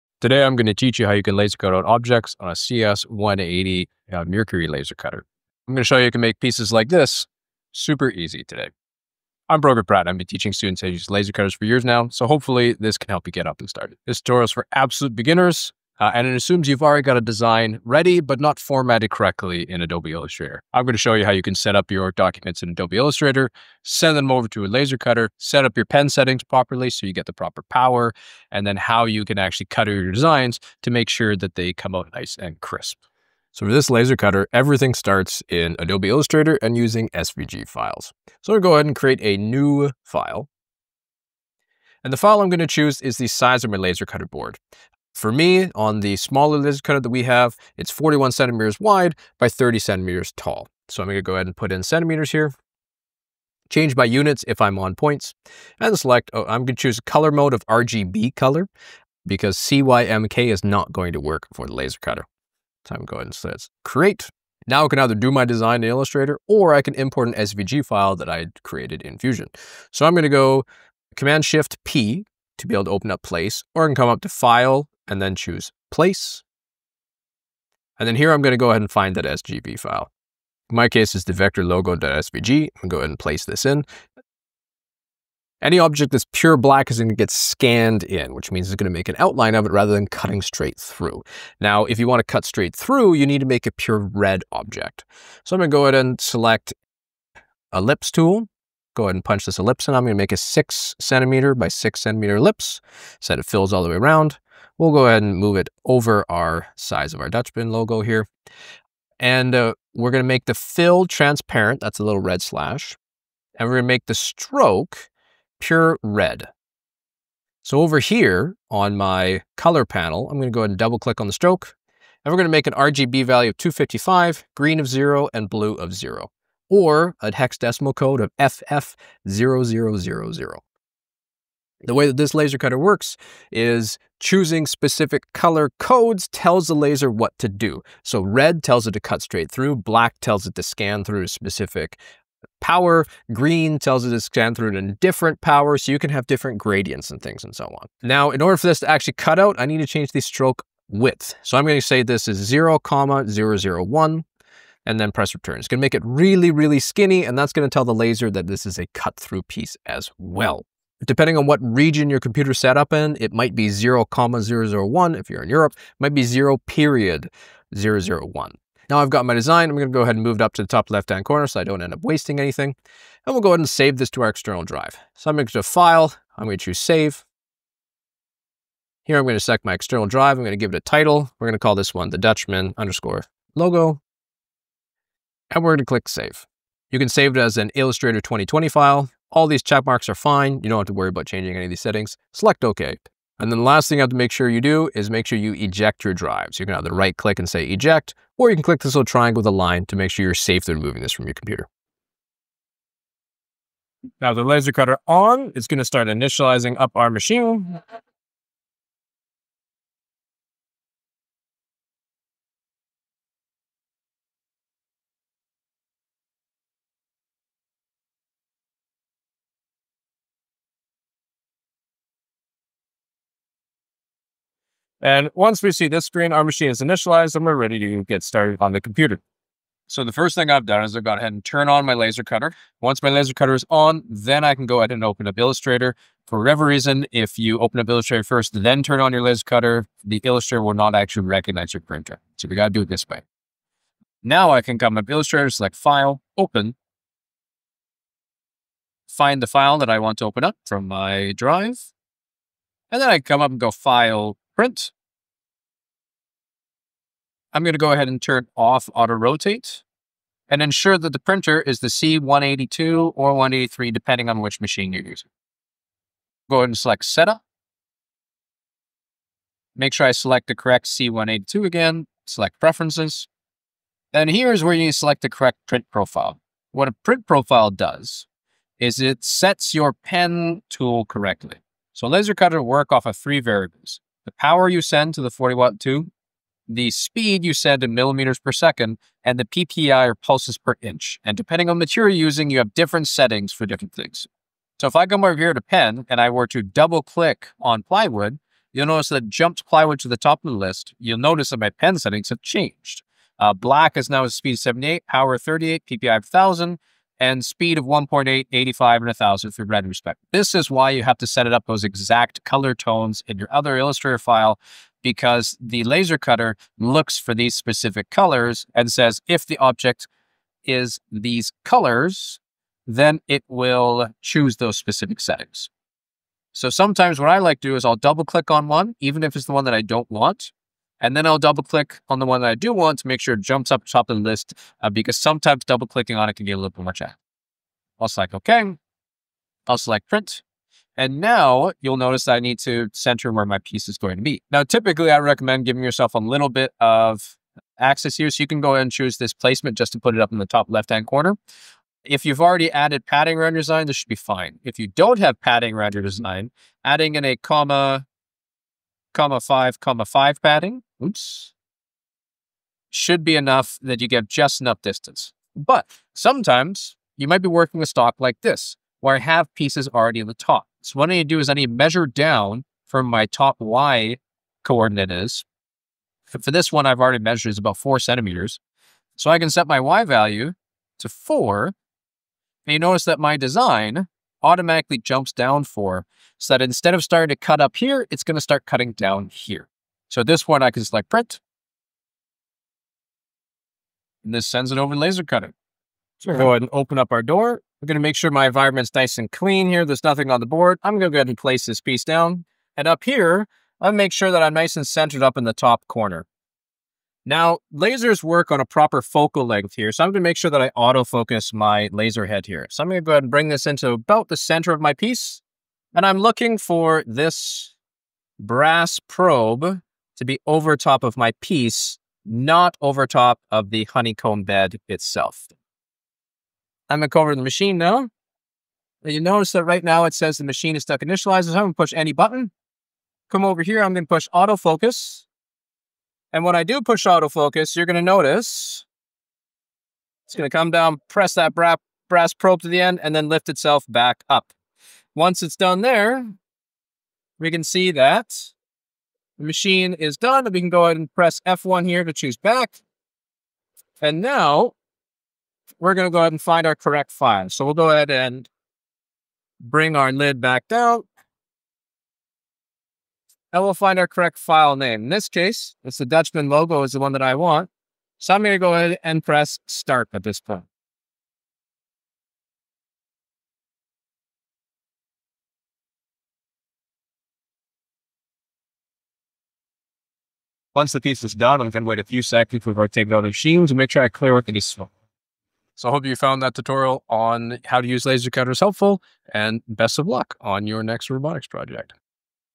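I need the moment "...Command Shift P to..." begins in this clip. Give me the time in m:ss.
1:11.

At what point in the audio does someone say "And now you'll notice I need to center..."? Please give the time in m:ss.
5:40.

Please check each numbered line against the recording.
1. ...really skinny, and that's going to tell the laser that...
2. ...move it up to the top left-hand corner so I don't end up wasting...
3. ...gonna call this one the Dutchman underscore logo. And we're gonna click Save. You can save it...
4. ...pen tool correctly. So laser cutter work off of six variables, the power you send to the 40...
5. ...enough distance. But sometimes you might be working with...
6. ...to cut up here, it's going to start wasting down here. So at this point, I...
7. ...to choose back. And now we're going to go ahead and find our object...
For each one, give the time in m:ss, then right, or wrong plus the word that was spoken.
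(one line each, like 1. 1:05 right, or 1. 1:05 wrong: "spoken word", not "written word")
1. 2:36 right
2. 2:50 right
3. 3:01 right
4. 4:39 wrong: "three", not "six"
5. 6:04 right
6. 6:27 wrong: "cutting", not "wasting"
7. 7:32 wrong: "correct", not "object".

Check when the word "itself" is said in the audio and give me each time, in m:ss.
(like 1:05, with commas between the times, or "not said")
7:04, 7:23.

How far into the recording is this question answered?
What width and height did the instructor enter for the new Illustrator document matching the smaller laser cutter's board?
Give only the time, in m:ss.
0:47.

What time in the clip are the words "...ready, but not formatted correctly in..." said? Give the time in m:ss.
0:17.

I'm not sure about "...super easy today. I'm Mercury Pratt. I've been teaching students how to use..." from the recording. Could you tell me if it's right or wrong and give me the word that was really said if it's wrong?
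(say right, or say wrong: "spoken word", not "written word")
wrong: "Brogan", not "Mercury".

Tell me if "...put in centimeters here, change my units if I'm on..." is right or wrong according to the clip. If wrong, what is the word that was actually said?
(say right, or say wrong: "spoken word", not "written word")
right.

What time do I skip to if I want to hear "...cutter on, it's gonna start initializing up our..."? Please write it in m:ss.
3:24.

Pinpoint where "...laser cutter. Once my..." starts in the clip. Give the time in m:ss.
3:51.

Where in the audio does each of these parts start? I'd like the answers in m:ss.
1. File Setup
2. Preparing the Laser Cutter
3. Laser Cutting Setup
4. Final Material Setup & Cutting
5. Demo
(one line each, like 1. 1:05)
1. 0:33
2. 3:22
3. 3:49
4. 6:38
5. 7:50.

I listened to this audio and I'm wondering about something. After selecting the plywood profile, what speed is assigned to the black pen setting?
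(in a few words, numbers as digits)
78.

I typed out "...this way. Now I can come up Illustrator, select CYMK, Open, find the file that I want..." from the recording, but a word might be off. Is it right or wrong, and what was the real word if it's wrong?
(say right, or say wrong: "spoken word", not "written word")
wrong: "File", not "CYMK".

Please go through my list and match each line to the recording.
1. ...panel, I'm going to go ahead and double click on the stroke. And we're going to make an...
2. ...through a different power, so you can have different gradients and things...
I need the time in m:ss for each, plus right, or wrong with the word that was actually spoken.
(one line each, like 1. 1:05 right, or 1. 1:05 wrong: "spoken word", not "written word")
1. 1:59 right
2. 2:24 right.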